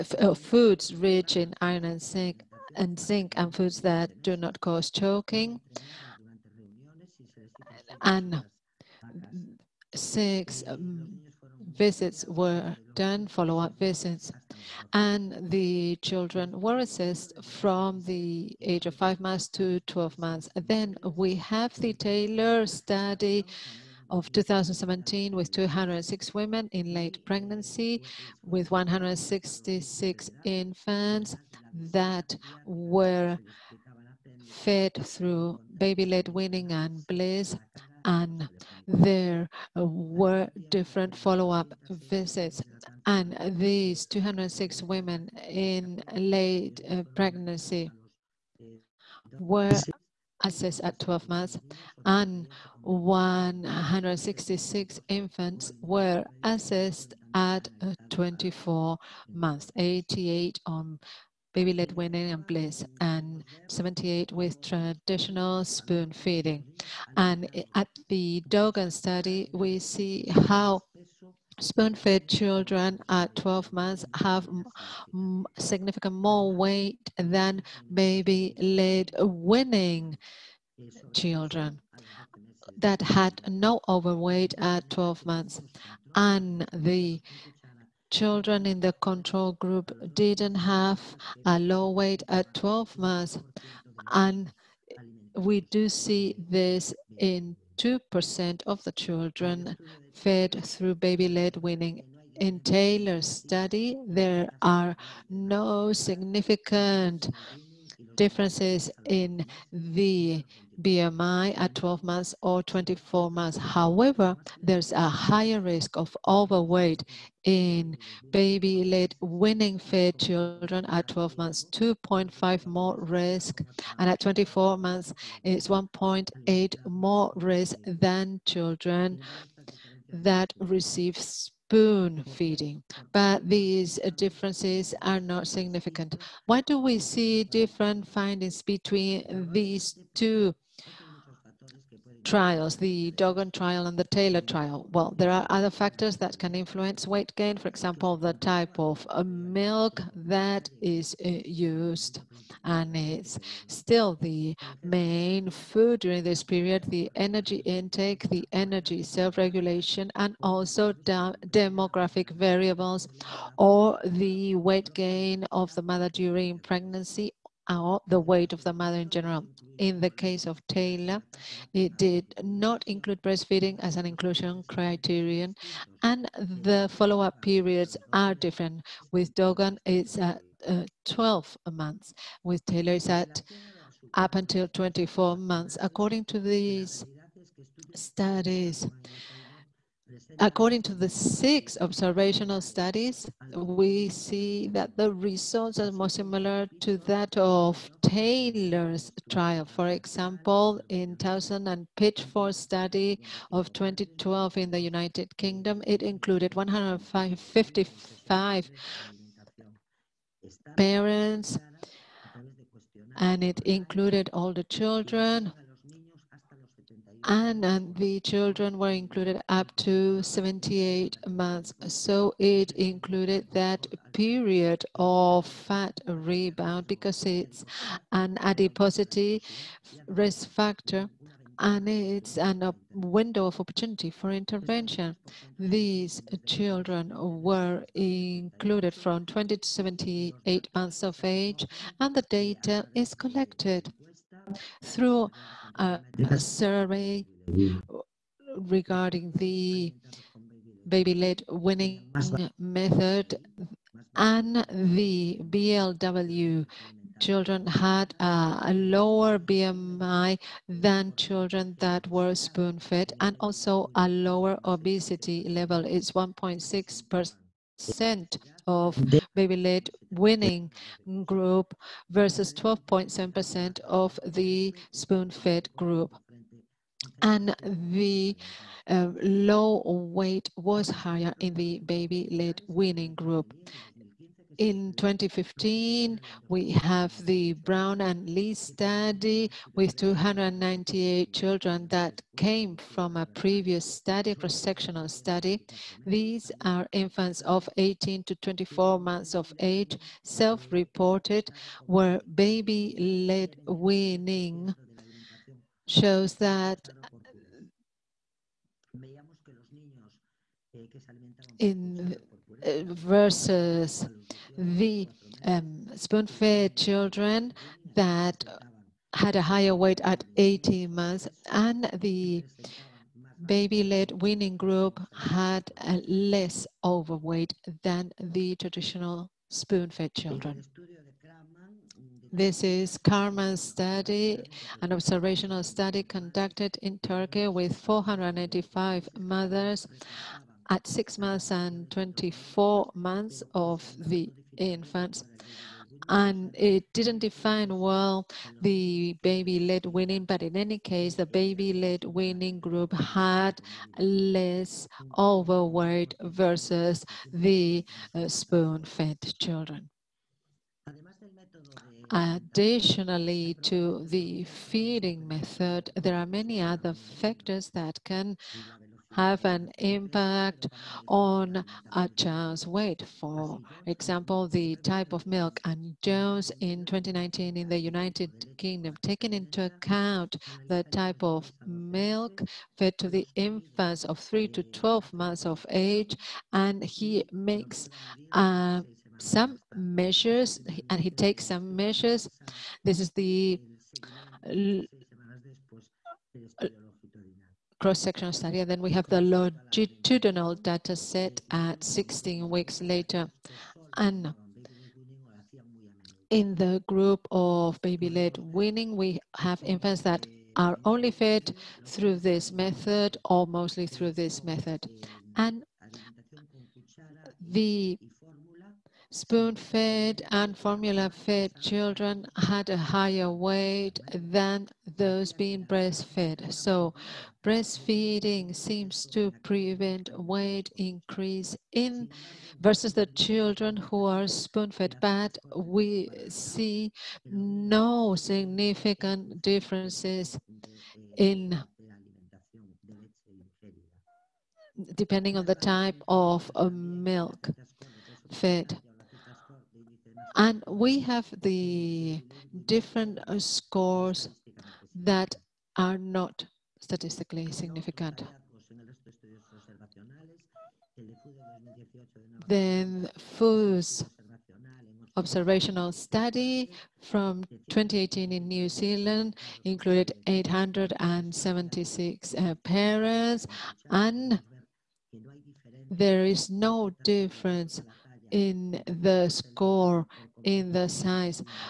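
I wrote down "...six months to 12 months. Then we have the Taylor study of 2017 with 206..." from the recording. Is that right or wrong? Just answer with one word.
wrong.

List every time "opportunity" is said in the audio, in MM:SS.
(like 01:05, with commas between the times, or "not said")
03:53.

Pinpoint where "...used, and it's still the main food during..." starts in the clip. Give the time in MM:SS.
02:31.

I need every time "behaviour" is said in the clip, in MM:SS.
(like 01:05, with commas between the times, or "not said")
not said.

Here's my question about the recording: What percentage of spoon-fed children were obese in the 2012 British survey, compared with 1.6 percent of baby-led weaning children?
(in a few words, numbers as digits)
12.7%.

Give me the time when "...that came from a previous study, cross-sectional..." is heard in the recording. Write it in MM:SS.
04:51.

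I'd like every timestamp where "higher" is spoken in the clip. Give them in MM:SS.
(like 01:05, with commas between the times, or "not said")
01:55, 04:40, 05:19, 07:02.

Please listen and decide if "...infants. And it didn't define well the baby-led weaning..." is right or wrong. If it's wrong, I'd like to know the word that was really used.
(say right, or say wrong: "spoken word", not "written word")
right.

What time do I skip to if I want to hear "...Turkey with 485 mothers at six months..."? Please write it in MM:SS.
05:36.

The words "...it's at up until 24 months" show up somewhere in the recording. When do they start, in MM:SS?
03:02.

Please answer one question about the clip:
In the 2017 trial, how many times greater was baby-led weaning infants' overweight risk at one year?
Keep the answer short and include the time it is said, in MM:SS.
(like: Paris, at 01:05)
2.5, at 02:01.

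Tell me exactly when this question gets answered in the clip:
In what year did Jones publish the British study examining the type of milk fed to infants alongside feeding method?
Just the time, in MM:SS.
06:16.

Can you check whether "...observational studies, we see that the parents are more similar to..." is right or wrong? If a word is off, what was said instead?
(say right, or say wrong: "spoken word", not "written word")
wrong: "results", not "parents".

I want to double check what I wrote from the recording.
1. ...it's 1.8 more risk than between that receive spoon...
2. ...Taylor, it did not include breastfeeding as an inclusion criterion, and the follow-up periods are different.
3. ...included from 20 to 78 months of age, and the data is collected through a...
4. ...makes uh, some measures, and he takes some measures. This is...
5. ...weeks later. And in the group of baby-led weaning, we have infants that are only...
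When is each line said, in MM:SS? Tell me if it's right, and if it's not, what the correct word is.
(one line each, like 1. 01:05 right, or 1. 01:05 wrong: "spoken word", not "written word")
1. 02:05 wrong: "children", not "between"
2. 02:50 right
3. 03:57 right
4. 06:27 right
5. 06:42 right.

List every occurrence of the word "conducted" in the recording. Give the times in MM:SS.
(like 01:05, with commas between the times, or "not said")
05:36.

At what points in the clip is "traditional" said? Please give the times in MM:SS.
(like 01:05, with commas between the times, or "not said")
01:04, 05:28.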